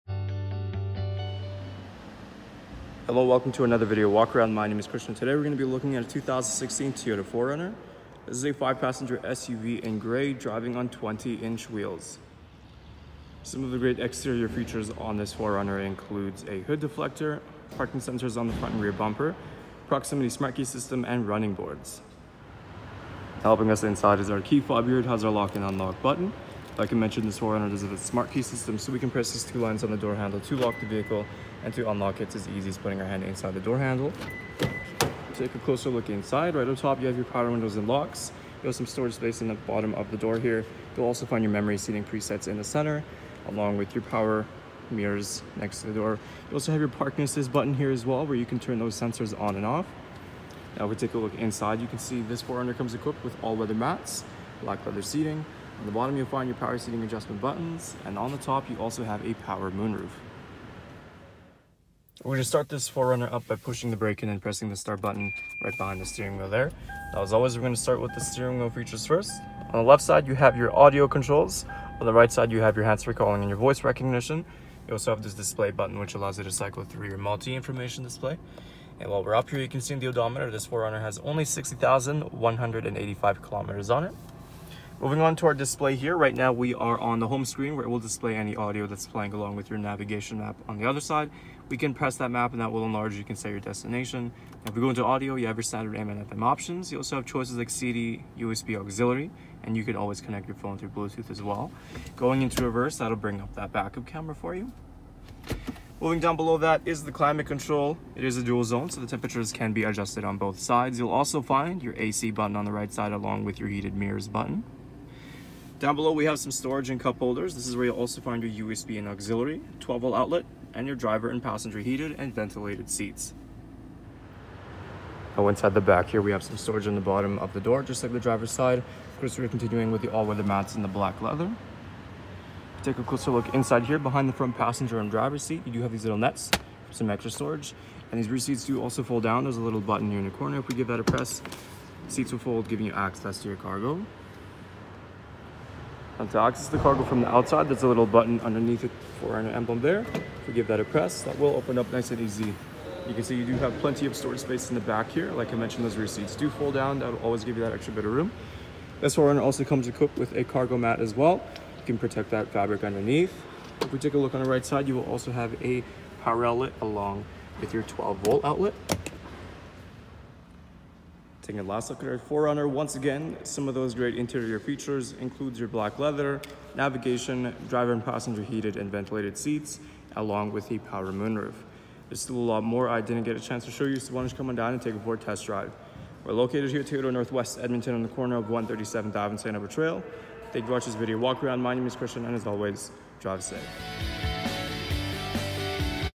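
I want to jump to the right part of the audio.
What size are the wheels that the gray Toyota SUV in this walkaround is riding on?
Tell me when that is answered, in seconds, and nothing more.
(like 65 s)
10 s.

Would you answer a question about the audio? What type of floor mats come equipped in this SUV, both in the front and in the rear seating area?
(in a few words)
All-weather mats.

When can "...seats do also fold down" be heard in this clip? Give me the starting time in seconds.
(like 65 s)
138 s.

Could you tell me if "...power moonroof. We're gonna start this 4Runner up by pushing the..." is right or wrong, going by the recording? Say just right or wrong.
right.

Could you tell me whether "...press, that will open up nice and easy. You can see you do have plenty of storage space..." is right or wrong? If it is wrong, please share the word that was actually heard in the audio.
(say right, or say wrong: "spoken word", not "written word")
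right.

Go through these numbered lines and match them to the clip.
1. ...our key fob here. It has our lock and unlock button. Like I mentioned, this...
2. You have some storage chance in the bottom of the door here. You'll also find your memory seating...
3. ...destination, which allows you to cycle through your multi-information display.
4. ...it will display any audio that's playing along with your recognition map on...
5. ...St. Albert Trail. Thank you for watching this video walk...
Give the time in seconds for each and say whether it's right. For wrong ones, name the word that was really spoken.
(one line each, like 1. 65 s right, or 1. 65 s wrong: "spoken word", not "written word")
1. 24 s right
2. 38 s wrong: "space", not "chance"
3. 75 s wrong: "button", not "destination"
4. 87 s wrong: "navigation", not "recognition"
5. 189 s right.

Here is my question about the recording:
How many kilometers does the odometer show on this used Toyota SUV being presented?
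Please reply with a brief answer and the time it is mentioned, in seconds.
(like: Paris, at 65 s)
60,185, at 81 s.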